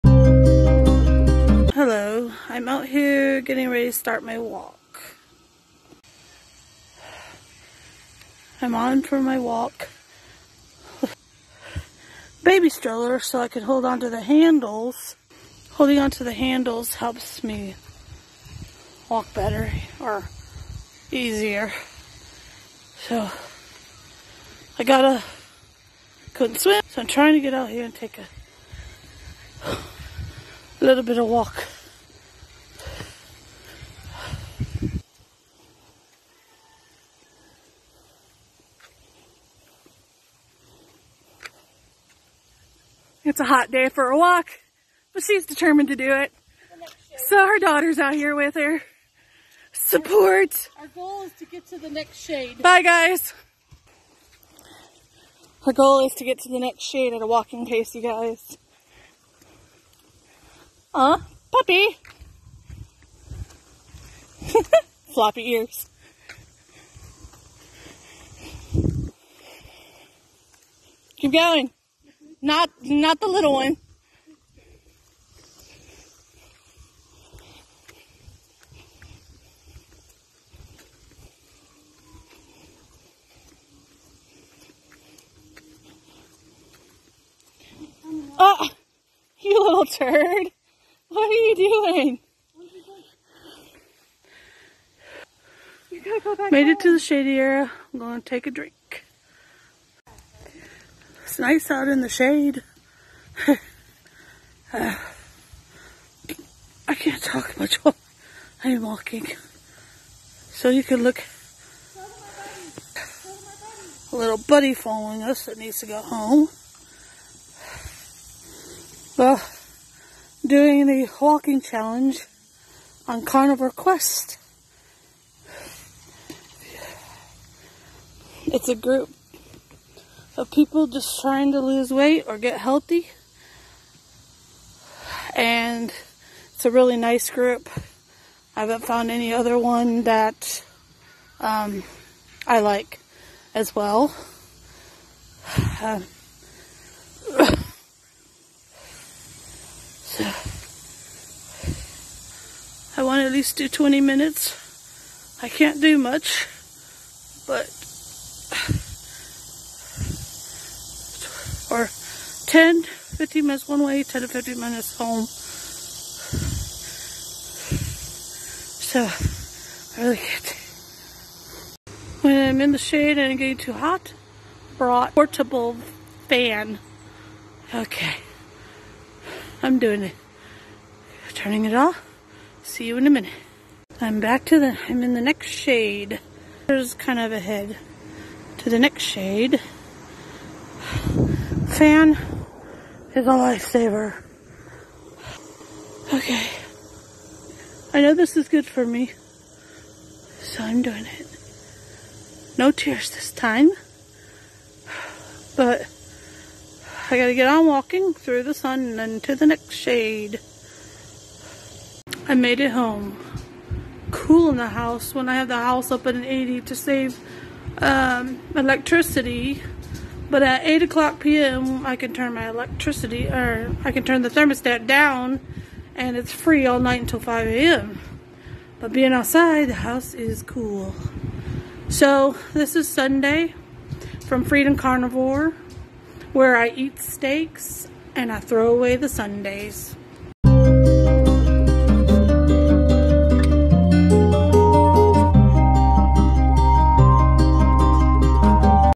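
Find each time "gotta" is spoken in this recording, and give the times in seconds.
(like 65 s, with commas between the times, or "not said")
24 s, 96 s, 207 s.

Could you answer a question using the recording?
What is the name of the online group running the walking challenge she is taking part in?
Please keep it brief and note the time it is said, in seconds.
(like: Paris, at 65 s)
Carnivore Quest, at 123 s.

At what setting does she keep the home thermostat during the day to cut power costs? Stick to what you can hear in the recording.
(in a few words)
80.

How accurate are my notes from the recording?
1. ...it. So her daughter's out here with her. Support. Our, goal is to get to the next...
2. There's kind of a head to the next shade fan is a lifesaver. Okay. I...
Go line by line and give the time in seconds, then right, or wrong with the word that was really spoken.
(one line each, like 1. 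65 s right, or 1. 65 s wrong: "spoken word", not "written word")
1. 46 s right
2. 186 s right.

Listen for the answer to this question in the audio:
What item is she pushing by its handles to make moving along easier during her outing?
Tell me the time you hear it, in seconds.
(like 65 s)
12 s.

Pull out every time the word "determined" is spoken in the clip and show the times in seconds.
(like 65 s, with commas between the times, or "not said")
45 s.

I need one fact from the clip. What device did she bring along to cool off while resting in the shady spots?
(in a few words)
Portable fan.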